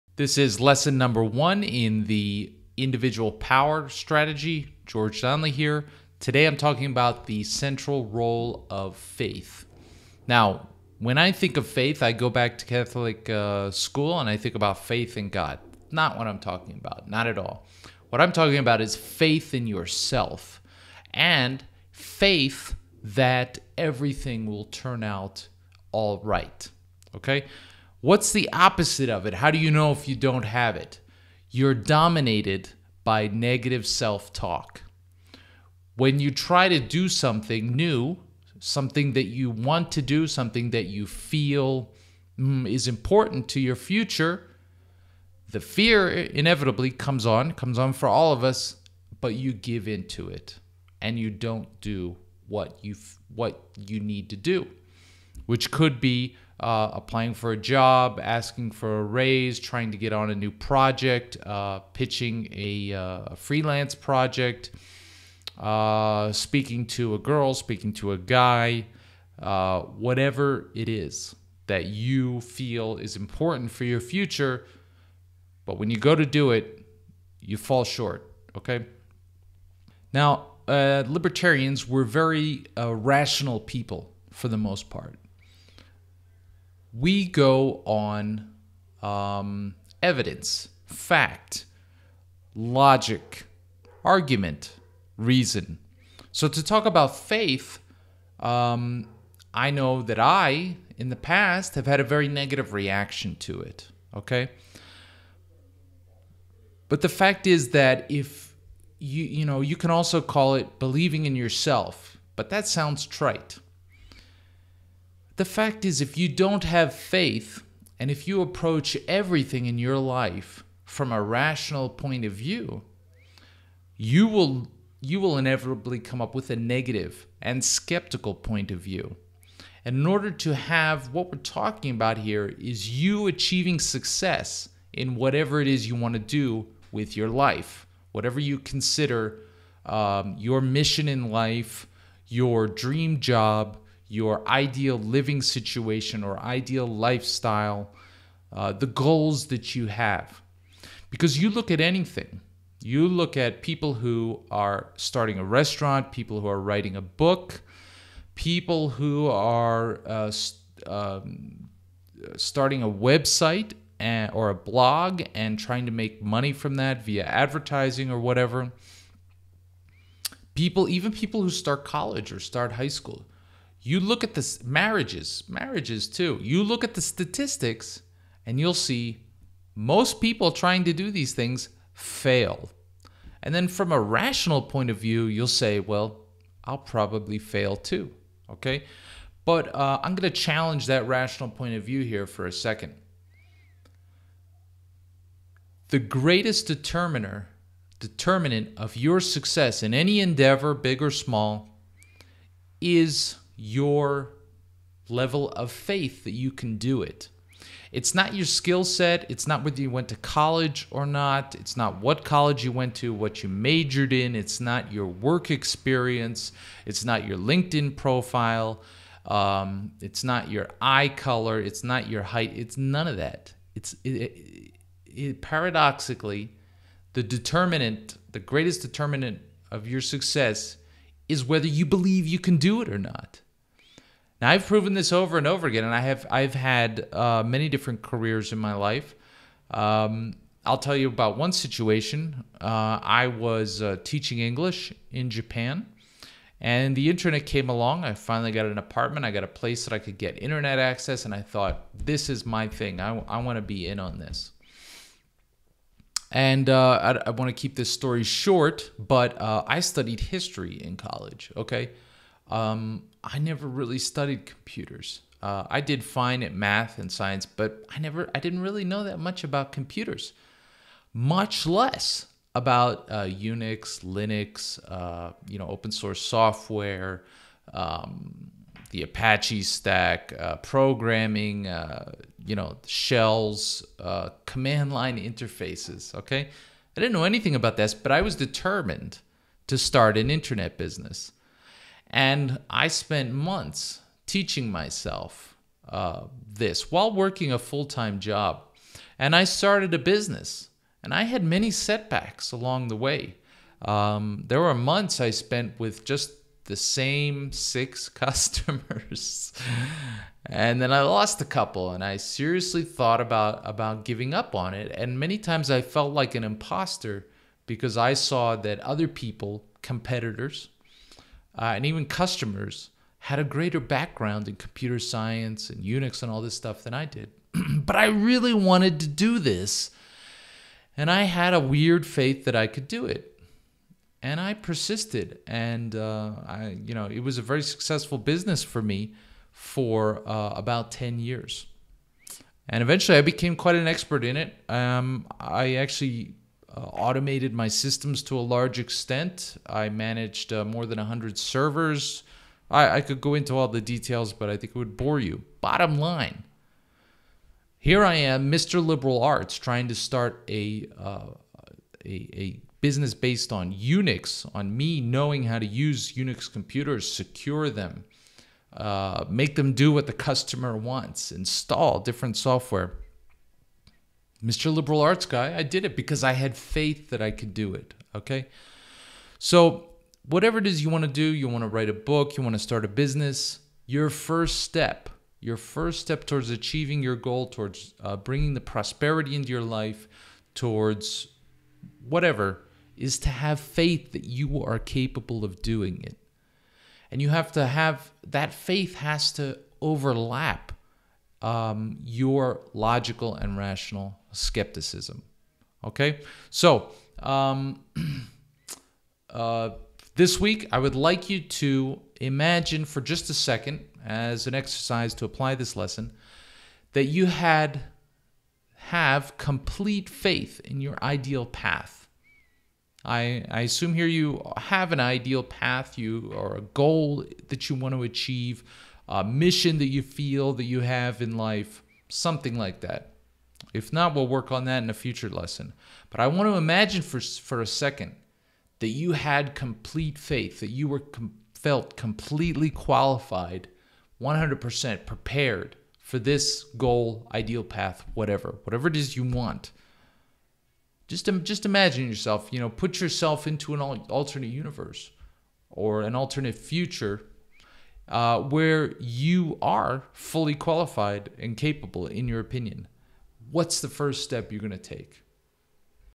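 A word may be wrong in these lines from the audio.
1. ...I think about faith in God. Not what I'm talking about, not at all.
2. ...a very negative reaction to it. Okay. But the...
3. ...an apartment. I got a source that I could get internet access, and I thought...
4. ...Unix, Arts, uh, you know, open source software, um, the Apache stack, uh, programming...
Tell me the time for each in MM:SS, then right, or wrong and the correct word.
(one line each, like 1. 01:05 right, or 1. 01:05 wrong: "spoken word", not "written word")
1. 00:14 right
2. 01:41 right
3. 04:08 wrong: "place", not "source"
4. 04:33 wrong: "Linux", not "Arts".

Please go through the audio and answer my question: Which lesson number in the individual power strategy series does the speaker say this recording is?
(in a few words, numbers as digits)
1.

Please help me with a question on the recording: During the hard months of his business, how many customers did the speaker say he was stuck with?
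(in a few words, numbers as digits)
6.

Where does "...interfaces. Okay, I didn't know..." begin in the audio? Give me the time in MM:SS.
04:45.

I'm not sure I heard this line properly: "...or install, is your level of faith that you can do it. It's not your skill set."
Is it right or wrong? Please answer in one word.
wrong.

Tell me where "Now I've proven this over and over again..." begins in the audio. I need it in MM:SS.
03:54.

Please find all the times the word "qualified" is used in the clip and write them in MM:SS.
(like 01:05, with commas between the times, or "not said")
07:22, 07:40.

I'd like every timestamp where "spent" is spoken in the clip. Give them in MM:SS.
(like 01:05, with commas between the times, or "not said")
04:52, 05:05.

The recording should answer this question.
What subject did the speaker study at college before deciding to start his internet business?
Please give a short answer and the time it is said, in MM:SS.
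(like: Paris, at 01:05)
History, at 04:20.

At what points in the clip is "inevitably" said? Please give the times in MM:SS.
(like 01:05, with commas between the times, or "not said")
00:46, 02:05.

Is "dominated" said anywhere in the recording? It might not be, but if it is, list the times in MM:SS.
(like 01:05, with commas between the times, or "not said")
00:31.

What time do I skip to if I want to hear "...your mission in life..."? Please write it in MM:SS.
02:20.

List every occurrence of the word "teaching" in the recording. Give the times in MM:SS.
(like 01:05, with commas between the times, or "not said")
04:04, 04:54.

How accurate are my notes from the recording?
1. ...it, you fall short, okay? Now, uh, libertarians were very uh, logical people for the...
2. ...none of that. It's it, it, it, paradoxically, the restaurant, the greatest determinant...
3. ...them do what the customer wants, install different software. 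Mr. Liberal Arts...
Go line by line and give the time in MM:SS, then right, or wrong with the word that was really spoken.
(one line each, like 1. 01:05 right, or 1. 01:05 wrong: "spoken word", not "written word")
1. 01:16 wrong: "rational", not "logical"
2. 03:42 wrong: "determinant", not "restaurant"
3. 06:09 right.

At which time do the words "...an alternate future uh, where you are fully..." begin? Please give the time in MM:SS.
07:36.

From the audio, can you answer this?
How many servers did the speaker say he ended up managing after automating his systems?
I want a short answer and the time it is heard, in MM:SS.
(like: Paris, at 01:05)
More than 100, at 05:50.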